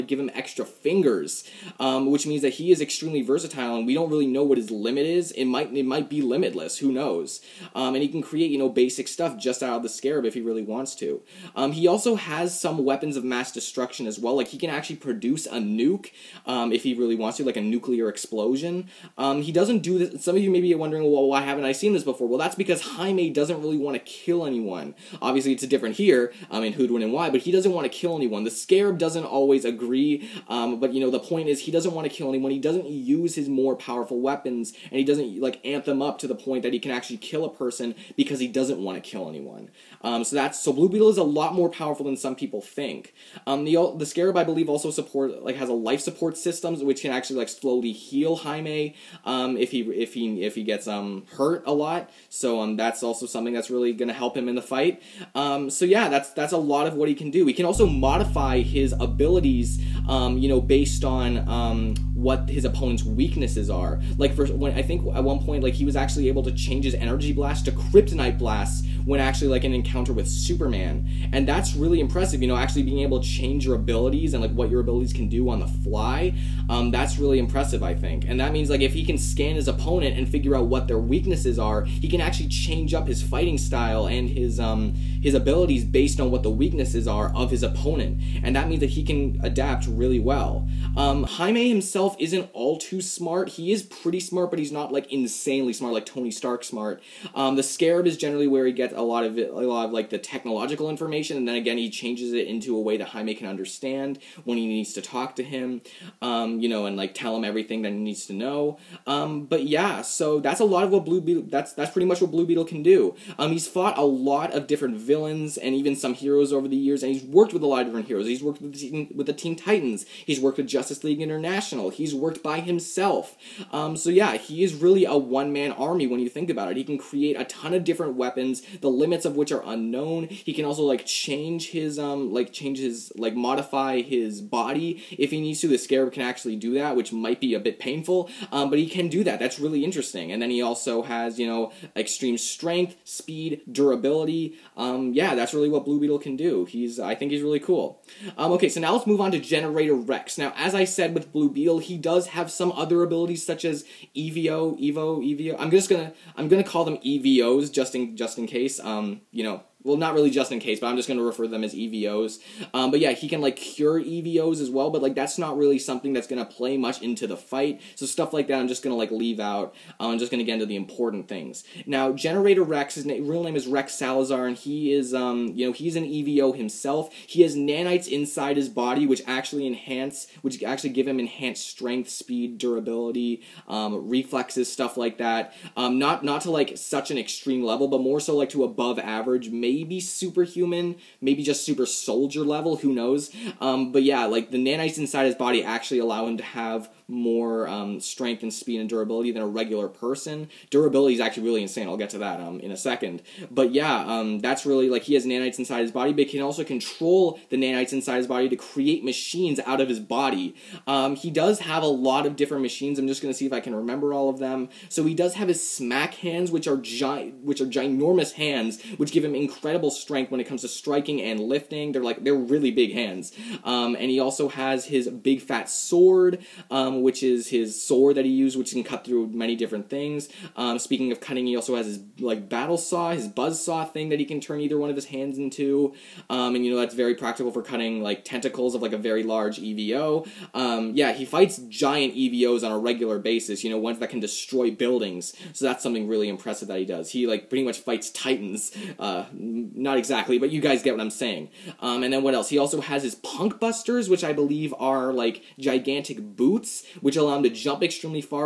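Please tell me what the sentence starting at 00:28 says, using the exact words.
The Scarab doesn't always agree, um, but you know, the point is he doesn't want to kill anyone.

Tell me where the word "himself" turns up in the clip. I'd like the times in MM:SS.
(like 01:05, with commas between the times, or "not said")
01:31, 02:02, 02:56.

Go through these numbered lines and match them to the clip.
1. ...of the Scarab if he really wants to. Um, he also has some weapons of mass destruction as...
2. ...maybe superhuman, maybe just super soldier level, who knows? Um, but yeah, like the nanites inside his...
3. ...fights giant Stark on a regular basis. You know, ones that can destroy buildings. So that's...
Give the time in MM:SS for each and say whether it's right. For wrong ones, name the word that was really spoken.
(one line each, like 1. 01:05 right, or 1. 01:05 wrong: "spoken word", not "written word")
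1. 00:09 right
2. 03:09 right
3. 04:01 wrong: "EVOs", not "Stark".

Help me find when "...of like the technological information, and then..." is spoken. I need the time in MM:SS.
01:39.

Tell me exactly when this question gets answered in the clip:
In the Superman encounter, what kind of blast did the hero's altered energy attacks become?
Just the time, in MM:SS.
01:07.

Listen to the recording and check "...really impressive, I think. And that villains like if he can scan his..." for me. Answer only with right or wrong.
wrong.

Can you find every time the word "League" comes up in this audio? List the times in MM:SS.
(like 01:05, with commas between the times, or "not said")
02:01.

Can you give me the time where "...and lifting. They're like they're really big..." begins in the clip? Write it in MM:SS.
03:41.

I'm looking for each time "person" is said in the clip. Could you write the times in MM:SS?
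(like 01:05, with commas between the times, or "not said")
00:37, 03:19.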